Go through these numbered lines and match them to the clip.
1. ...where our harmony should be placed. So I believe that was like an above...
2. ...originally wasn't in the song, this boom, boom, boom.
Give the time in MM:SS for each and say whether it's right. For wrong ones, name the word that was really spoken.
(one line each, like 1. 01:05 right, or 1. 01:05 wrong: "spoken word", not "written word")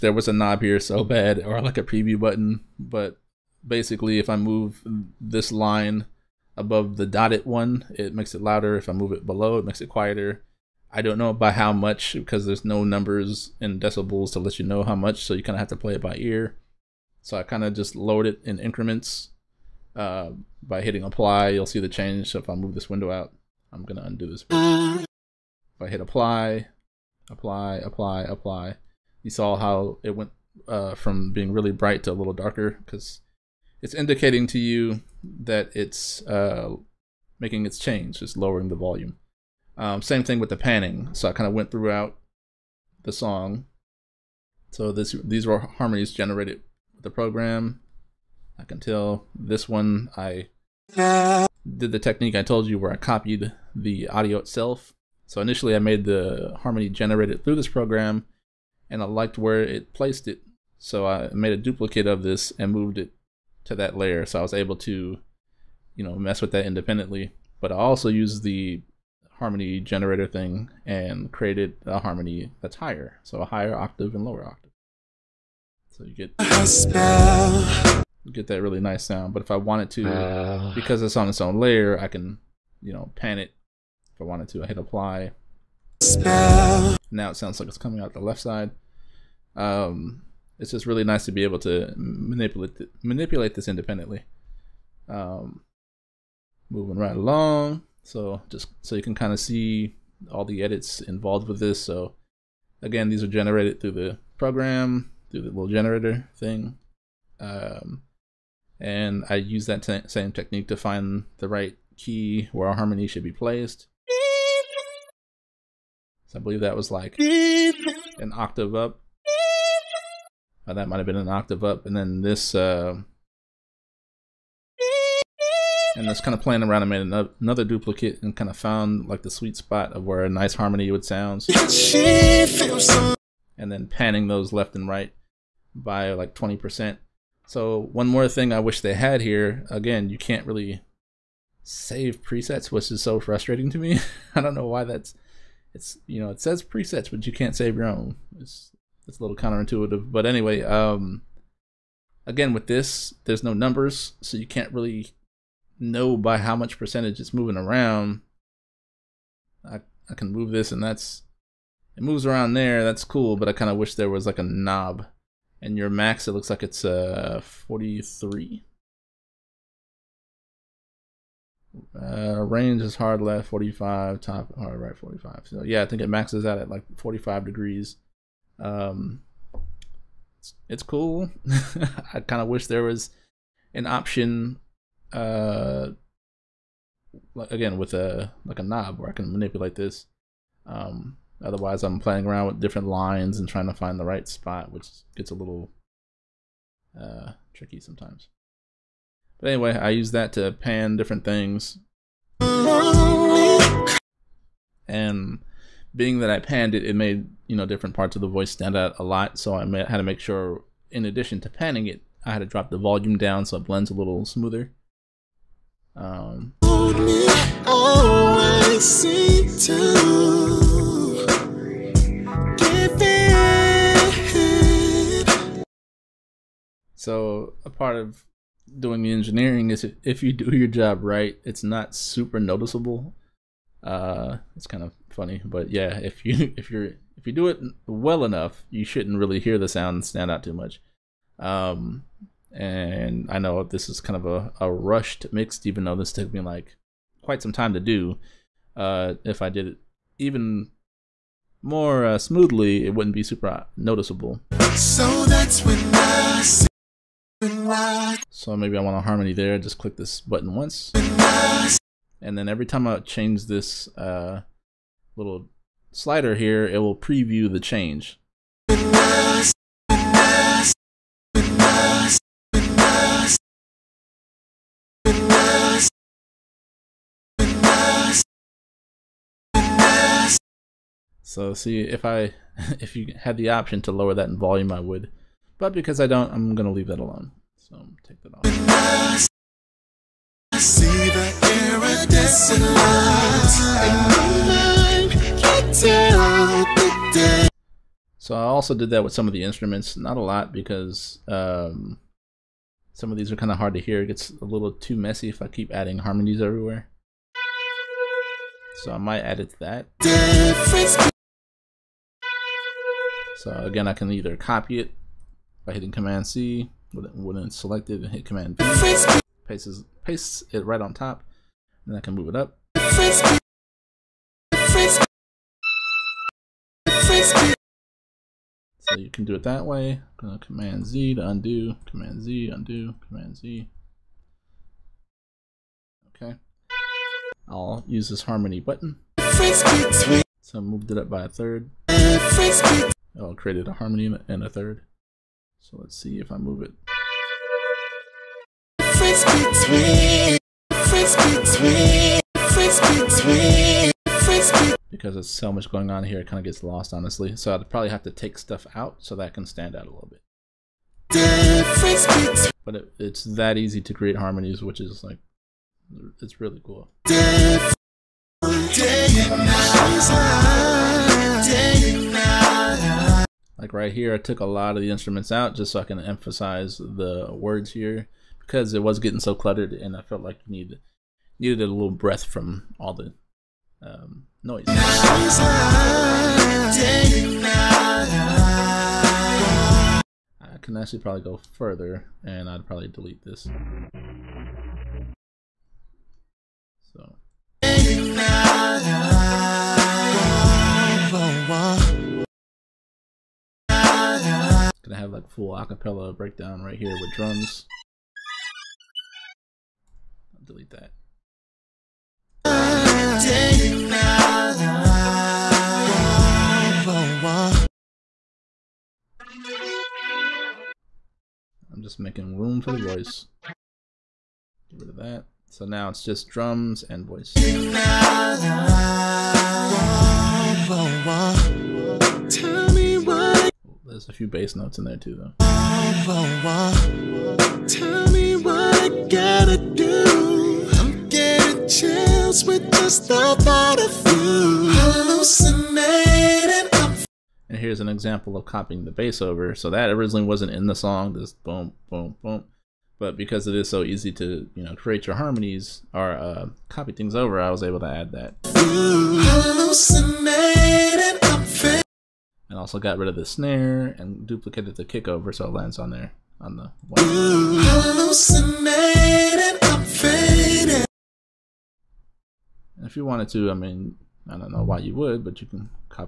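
1. 01:52 wrong: "octave", not "above"
2. 07:29 right.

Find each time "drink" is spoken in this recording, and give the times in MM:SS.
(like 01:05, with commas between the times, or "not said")
not said.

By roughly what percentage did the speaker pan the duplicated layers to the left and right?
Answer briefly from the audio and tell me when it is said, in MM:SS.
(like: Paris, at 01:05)
20%, at 02:16.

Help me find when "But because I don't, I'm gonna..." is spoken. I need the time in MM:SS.
04:45.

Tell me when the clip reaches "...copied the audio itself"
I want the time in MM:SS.
00:52.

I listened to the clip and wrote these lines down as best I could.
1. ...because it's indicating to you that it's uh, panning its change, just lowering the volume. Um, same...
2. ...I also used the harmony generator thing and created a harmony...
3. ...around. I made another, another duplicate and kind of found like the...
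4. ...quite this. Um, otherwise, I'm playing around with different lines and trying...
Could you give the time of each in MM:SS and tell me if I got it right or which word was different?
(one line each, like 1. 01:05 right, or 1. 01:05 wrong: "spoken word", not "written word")
1. 00:32 wrong: "making", not "panning"
2. 01:07 right
3. 02:06 right
4. 03:09 wrong: "manipulate", not "quite".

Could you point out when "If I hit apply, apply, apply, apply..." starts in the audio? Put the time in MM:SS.
00:24.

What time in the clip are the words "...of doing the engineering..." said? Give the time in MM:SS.
03:47.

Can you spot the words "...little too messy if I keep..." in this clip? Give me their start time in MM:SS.
05:04.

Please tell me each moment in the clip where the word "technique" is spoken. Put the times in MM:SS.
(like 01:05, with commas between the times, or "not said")
00:51, 01:50.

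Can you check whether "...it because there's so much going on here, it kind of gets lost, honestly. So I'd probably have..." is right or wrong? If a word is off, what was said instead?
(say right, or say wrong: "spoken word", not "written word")
right.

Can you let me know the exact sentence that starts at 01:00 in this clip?
So I made a duplicate of this and moved it to that layer.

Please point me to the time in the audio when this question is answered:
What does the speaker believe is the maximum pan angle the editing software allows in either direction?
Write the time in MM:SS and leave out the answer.
02:56.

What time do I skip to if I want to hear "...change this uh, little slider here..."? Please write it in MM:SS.
04:22.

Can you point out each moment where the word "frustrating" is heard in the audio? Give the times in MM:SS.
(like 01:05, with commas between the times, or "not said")
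02:23.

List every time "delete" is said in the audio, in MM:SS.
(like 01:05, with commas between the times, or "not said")
06:32, 06:50.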